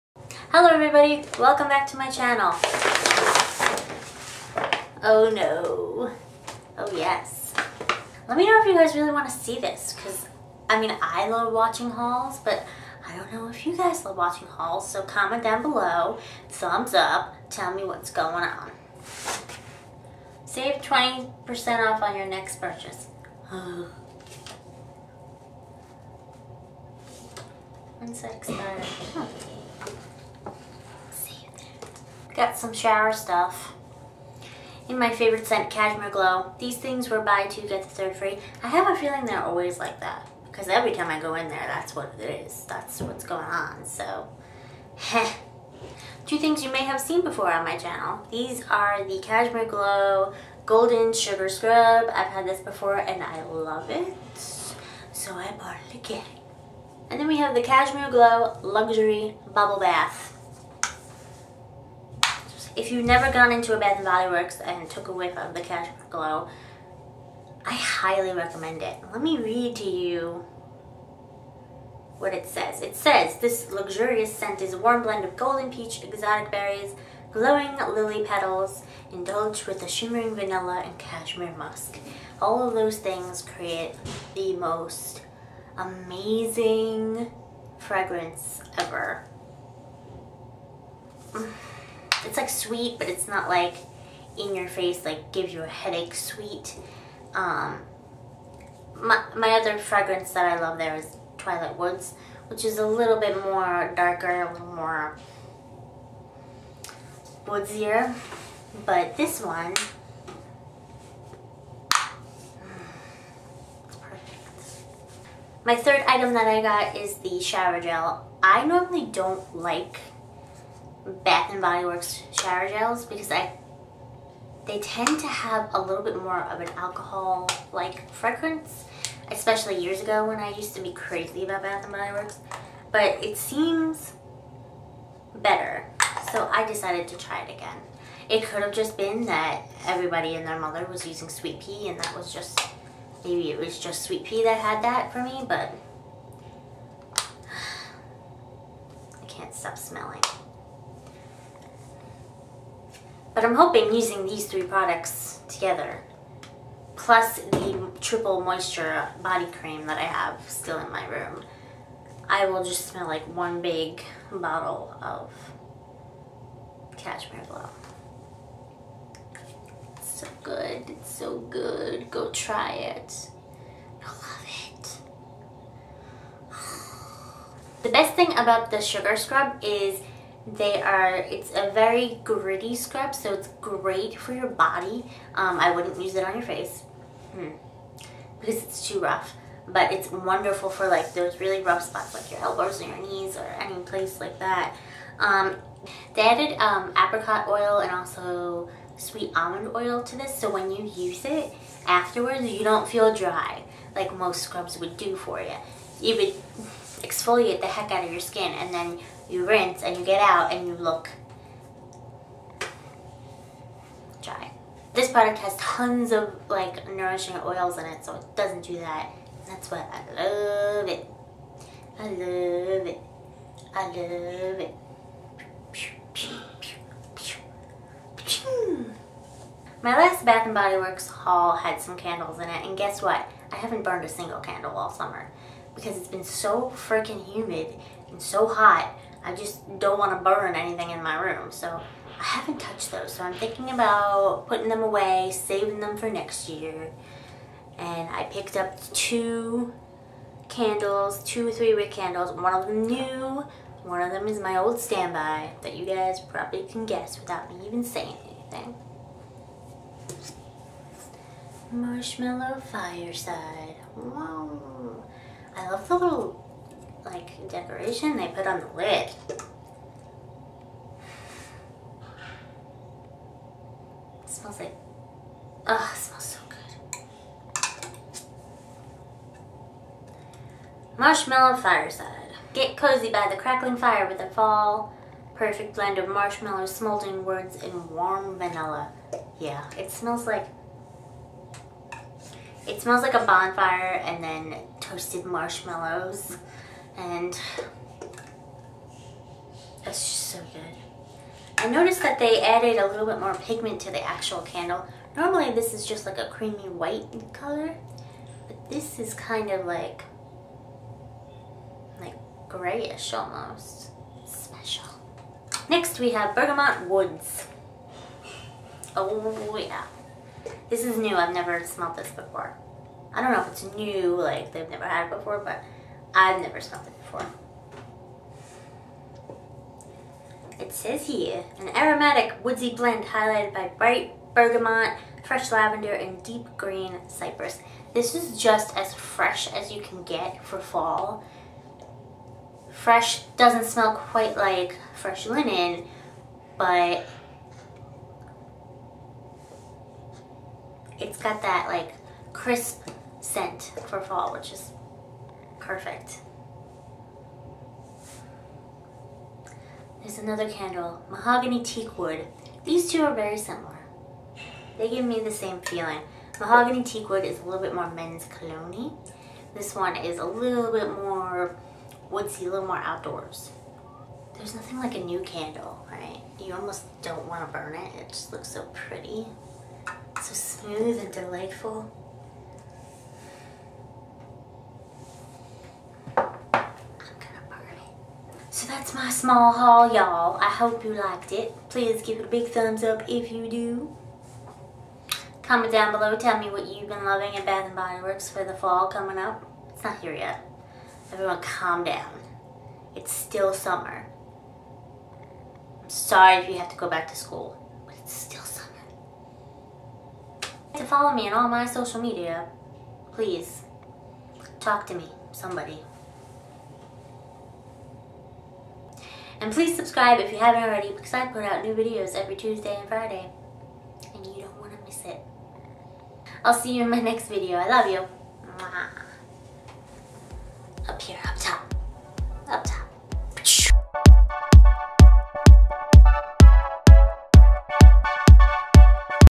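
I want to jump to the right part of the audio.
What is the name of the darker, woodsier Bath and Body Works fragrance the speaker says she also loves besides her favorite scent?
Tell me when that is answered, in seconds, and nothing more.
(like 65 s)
101 s.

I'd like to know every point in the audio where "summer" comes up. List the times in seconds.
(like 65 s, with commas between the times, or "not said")
234 s, 403 s, 408 s.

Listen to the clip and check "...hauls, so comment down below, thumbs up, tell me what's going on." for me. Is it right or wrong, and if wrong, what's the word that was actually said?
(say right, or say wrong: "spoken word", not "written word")
right.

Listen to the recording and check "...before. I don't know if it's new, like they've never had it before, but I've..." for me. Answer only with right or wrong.
right.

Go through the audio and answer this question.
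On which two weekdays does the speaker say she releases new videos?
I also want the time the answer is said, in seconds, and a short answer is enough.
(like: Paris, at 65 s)
Tuesday and Friday, at 422 s.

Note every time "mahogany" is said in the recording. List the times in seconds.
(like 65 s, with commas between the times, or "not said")
361 s, 366 s.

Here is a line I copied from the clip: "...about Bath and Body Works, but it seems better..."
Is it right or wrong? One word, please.
right.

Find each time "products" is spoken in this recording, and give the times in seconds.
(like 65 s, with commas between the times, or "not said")
154 s, 215 s.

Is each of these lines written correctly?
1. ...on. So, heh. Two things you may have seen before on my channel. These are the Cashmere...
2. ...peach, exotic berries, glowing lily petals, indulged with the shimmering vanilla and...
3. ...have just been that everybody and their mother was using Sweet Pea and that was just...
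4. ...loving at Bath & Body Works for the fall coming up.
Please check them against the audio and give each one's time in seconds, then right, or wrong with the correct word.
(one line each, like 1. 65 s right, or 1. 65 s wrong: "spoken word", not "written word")
1. 43 s right
2. 75 s right
3. 138 s right
4. 397 s right.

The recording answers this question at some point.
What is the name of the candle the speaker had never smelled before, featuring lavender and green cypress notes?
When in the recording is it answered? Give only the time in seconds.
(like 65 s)
316 s.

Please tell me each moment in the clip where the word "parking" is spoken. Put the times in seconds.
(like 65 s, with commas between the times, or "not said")
not said.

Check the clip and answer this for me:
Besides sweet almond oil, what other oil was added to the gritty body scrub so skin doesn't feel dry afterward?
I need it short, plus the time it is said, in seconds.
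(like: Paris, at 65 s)
apricot oil, at 196 s.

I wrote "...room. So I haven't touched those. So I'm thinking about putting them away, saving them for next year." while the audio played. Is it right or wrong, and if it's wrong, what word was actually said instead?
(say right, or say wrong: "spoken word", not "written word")
right.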